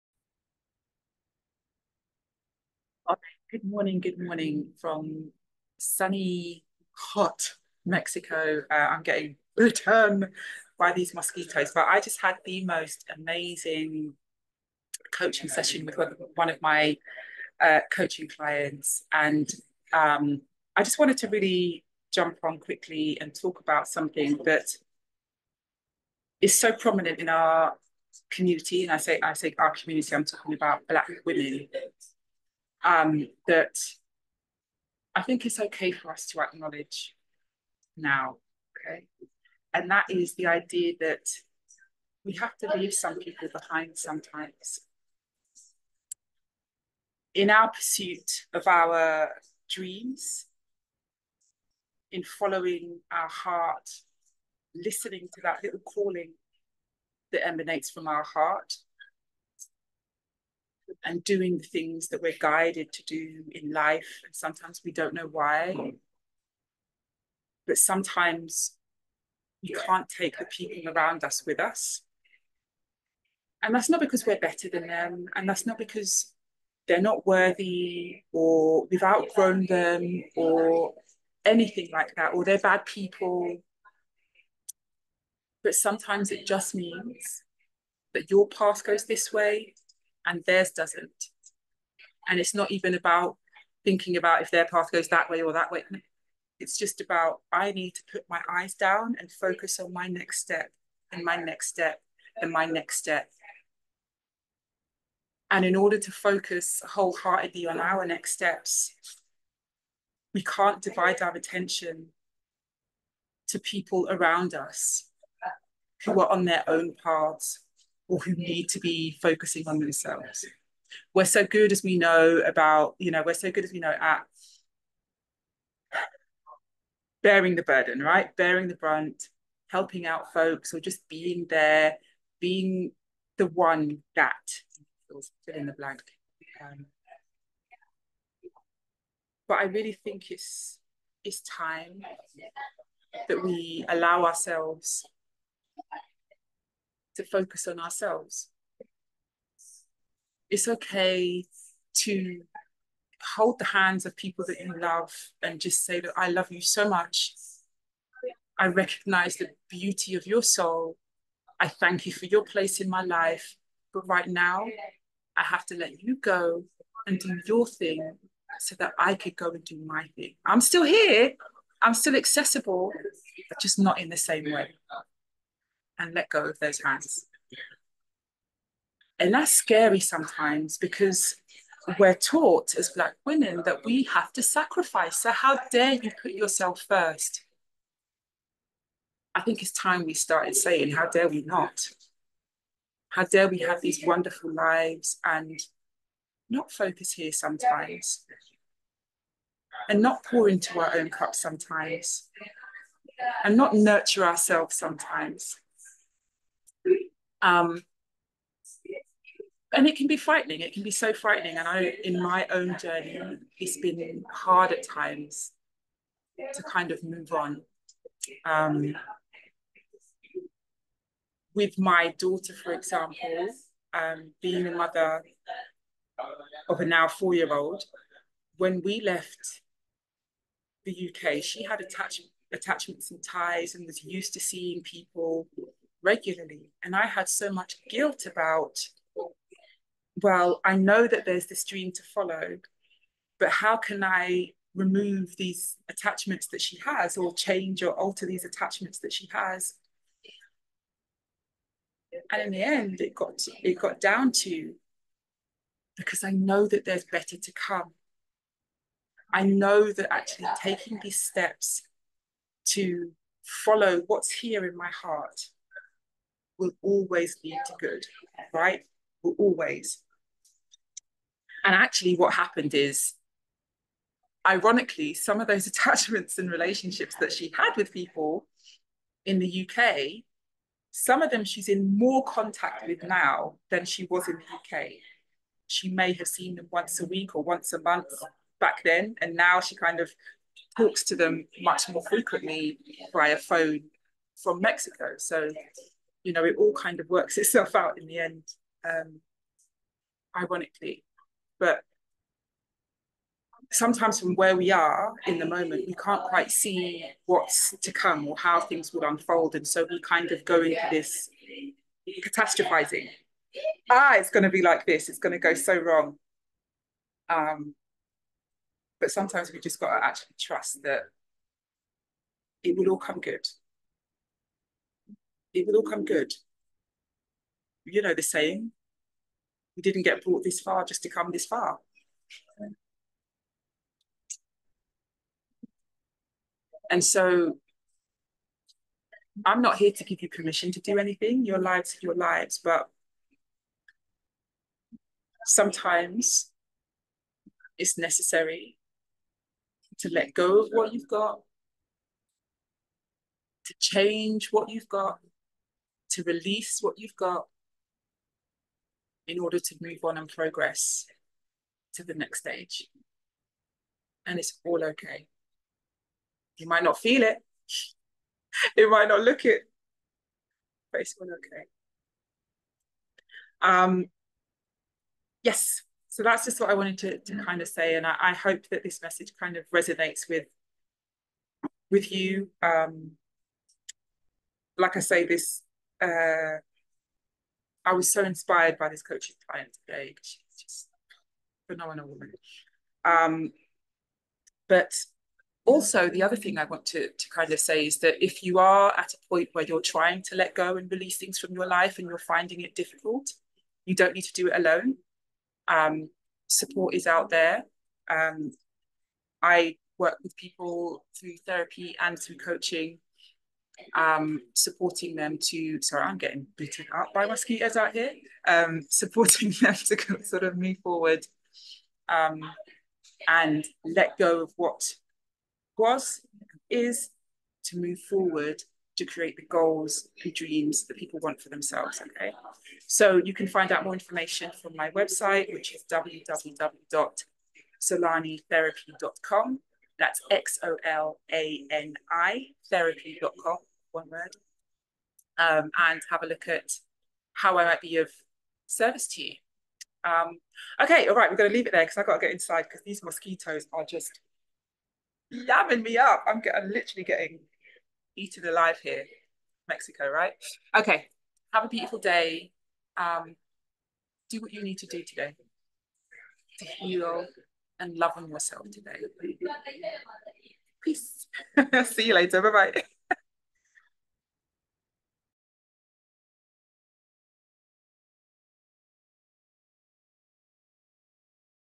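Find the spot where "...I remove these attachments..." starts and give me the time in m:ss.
4:04.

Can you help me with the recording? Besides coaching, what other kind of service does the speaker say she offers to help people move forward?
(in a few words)
therapy.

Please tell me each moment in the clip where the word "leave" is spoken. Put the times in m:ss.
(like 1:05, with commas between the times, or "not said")
0:42, 7:31.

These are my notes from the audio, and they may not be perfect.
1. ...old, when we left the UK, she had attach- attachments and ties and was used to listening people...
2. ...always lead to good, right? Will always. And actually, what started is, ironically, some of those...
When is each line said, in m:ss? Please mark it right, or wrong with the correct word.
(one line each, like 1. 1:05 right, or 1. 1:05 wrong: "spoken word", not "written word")
1. 3:47 wrong: "seeing", not "listening"
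2. 4:26 wrong: "happened", not "started".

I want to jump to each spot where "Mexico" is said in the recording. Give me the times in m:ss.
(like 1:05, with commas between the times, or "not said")
0:07, 4:54, 7:39.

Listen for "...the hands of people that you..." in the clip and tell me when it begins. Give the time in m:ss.
2:33.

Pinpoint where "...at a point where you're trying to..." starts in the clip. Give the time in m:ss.
6:38.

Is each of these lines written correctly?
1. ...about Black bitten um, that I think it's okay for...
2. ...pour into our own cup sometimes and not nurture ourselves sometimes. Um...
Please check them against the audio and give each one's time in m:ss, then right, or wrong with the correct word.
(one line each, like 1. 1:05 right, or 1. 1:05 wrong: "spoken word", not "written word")
1. 0:30 wrong: "women", not "bitten"
2. 3:20 right.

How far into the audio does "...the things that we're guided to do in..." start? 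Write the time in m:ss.
1:01.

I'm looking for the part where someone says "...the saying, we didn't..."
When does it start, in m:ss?
5:28.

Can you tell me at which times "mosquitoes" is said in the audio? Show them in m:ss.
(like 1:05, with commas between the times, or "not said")
0:11, 6:57, 7:33.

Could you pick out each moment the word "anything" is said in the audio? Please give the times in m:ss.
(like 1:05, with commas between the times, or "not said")
1:21, 5:40.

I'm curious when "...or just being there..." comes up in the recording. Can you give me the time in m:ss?
2:10.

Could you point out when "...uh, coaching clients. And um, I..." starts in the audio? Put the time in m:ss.
0:17.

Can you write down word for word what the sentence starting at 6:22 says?
Um, like I say, this uh, I was so inspired by this coach's client today.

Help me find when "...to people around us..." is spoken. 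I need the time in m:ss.
1:53.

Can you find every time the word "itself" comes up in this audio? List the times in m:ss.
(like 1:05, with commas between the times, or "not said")
4:57.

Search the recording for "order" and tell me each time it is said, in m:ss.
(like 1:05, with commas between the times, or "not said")
1:45, 5:59.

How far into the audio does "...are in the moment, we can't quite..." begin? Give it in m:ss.
5:04.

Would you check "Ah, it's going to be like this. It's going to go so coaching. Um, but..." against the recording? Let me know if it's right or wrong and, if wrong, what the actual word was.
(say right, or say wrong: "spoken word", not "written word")
wrong: "wrong", not "coaching".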